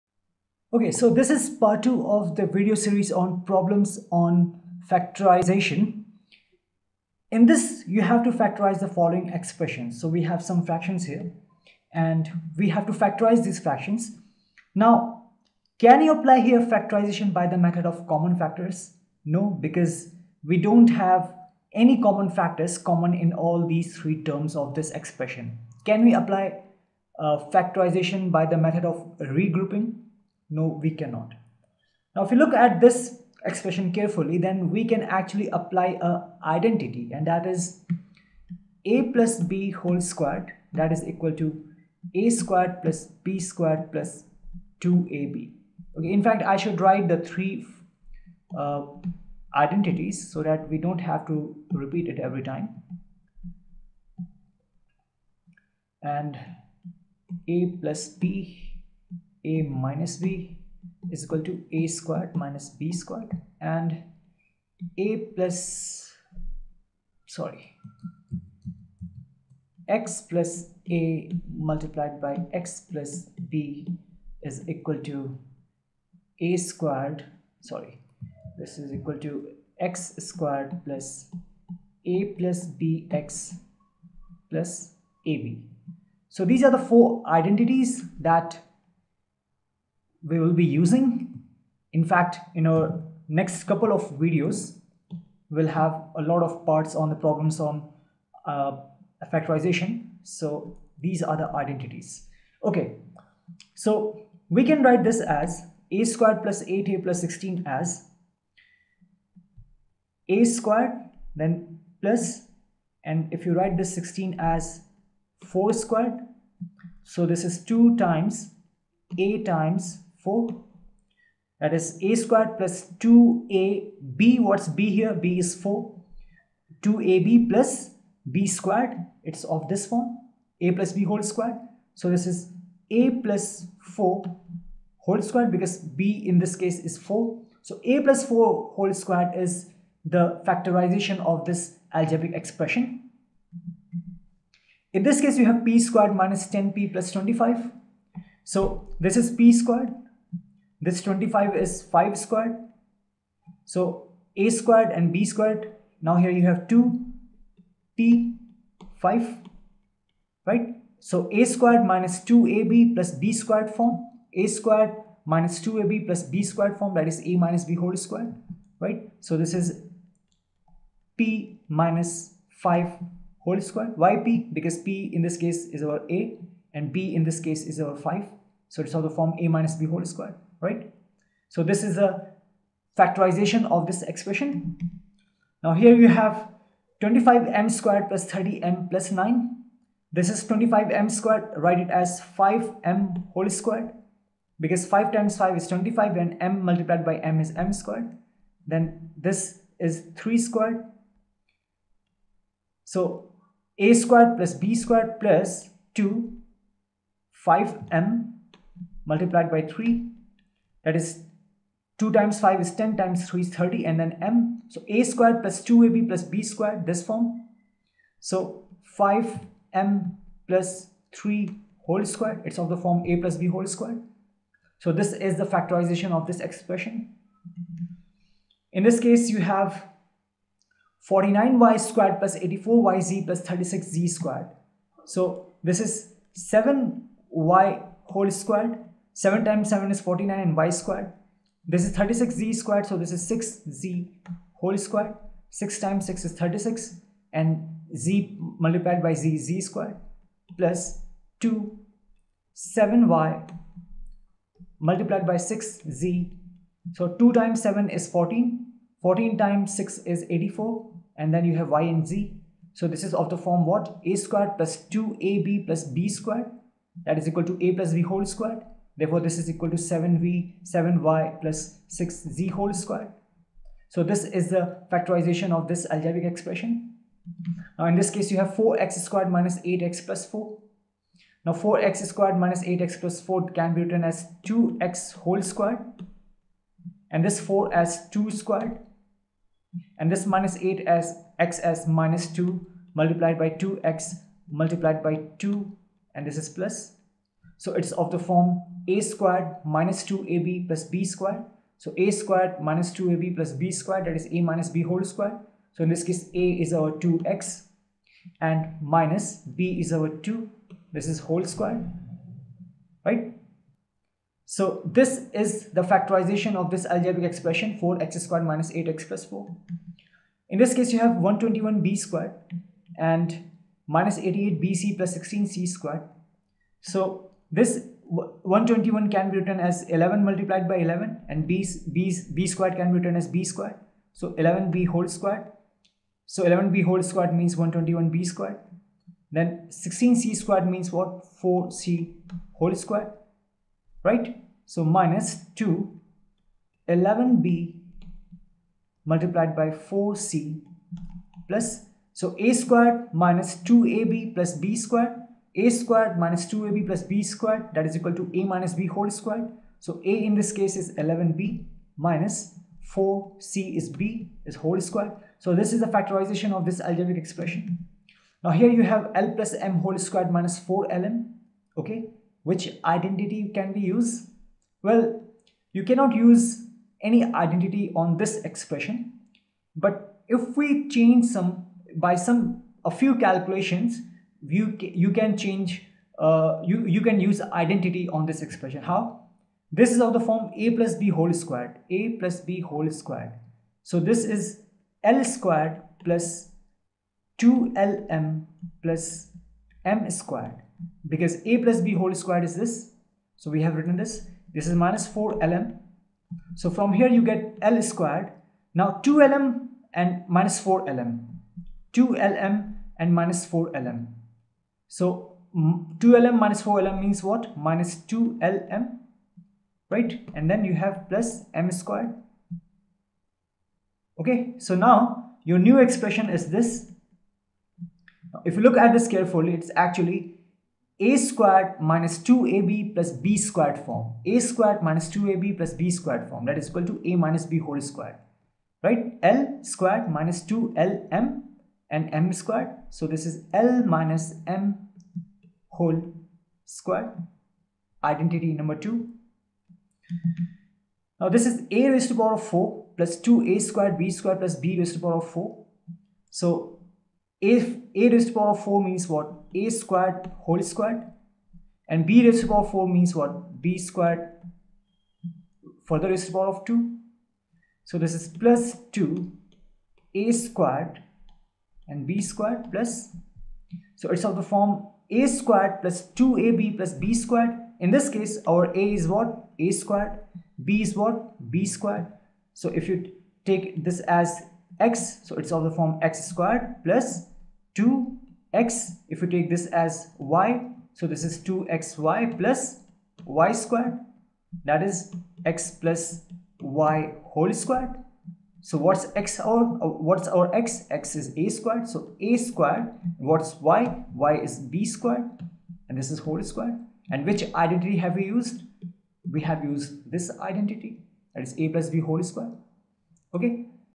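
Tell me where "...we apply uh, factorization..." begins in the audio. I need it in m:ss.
0:26.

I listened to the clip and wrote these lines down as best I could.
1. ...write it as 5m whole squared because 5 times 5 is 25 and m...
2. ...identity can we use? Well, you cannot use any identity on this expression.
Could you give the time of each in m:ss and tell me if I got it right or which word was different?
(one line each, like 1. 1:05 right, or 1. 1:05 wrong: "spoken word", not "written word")
1. 3:11 right
2. 6:12 right.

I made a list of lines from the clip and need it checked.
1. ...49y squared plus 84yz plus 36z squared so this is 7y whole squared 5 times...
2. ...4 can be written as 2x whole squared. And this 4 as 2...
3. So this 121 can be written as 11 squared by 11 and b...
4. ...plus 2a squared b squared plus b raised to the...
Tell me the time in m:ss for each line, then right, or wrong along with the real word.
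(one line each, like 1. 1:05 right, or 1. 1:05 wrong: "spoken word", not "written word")
1. 3:51 wrong: "7", not "5"
2. 4:43 right
3. 5:26 wrong: "multiplied", not "squared"
4. 7:32 right.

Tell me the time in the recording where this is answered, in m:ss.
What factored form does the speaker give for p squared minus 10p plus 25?
2:51.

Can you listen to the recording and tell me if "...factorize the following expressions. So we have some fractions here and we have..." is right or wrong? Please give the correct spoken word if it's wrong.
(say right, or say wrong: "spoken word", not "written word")
right.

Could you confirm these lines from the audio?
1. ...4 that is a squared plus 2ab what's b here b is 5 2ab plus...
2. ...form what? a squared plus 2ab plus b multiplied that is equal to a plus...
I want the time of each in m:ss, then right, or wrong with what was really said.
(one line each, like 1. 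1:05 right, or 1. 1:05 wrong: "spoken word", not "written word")
1. 2:00 wrong: "4", not "5"
2. 4:23 wrong: "squared", not "multiplied".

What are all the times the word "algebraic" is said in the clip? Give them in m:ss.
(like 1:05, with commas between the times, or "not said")
2:21, 4:35, 5:16, 6:06.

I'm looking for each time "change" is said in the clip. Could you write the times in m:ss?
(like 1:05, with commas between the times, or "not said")
6:20, 6:25.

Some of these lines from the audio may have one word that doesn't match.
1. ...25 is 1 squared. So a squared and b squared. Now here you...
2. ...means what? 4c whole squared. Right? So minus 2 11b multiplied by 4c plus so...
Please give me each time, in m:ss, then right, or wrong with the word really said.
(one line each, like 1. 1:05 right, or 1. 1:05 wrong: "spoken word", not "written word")
1. 2:31 wrong: "5", not "1"
2. 5:40 right.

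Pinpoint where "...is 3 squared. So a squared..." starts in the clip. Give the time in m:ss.
3:19.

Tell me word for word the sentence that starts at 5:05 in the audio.
So in this case a is our 2x and minus b is our 2 this is whole squared right.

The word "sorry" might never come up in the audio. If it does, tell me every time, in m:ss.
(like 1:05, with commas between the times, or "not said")
1:07, 1:17.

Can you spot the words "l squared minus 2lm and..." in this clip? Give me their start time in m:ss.
7:19.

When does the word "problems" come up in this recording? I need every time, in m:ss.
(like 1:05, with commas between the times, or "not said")
0:03, 1:37.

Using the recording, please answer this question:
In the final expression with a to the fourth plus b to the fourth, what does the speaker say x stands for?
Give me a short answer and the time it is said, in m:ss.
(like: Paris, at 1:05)
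a², at 8:20.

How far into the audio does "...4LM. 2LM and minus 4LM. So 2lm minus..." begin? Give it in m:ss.
6:50.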